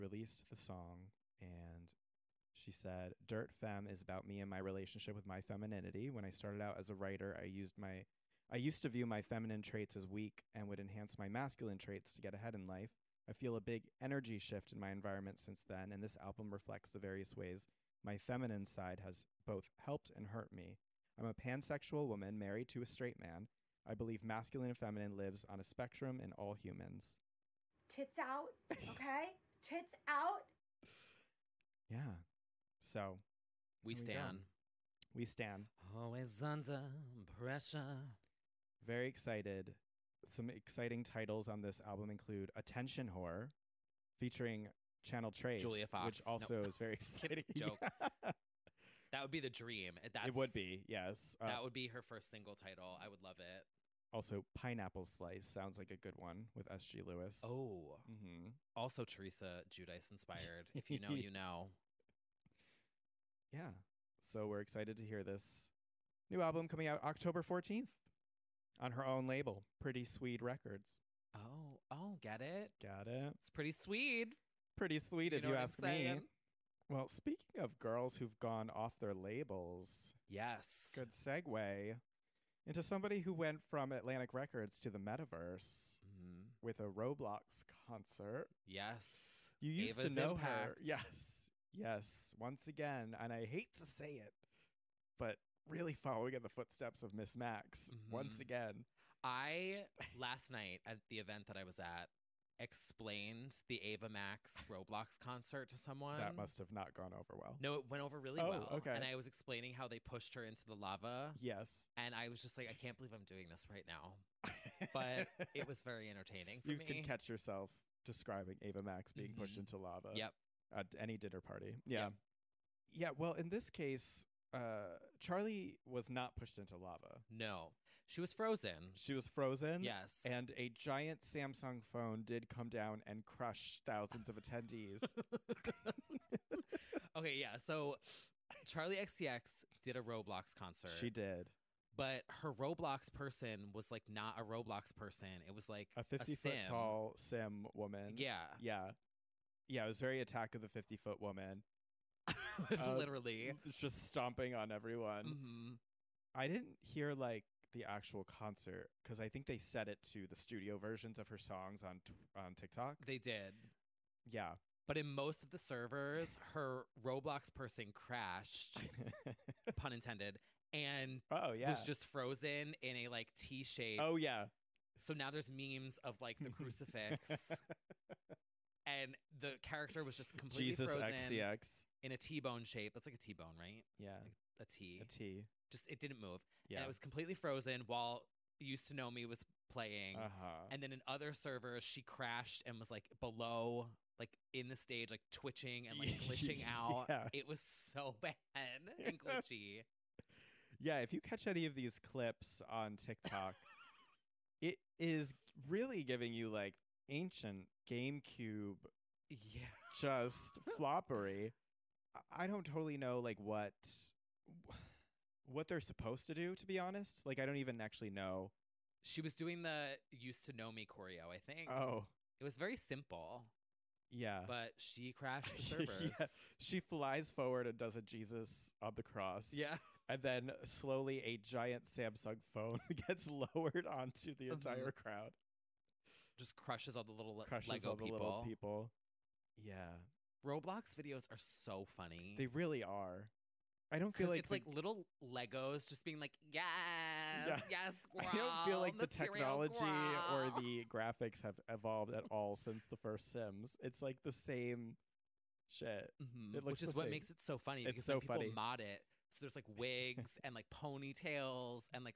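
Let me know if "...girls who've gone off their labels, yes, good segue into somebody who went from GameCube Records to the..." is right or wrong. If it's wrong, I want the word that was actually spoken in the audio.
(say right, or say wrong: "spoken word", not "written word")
wrong: "Atlantic", not "GameCube".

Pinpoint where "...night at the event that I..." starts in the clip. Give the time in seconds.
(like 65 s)
100 s.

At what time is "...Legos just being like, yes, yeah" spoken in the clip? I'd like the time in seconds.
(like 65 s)
245 s.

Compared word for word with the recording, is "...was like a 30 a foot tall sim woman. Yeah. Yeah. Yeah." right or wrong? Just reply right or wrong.
wrong.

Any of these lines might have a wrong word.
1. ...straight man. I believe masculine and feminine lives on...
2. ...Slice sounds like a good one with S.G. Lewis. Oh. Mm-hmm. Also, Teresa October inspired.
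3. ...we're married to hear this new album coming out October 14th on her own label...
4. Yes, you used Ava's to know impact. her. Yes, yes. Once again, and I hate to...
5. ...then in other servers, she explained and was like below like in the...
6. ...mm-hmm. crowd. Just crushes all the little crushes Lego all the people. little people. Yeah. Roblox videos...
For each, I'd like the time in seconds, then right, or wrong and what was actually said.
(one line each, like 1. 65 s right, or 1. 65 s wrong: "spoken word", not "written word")
1. 22 s right
2. 55 s wrong: "Giudice", not "October"
3. 64 s wrong: "excited", not "married"
4. 88 s right
5. 190 s wrong: "crashed", not "explained"
6. 234 s right.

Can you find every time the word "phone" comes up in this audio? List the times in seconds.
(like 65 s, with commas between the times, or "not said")
131 s, 232 s.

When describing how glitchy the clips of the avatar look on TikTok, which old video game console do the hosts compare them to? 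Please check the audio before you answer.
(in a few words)
GameCube.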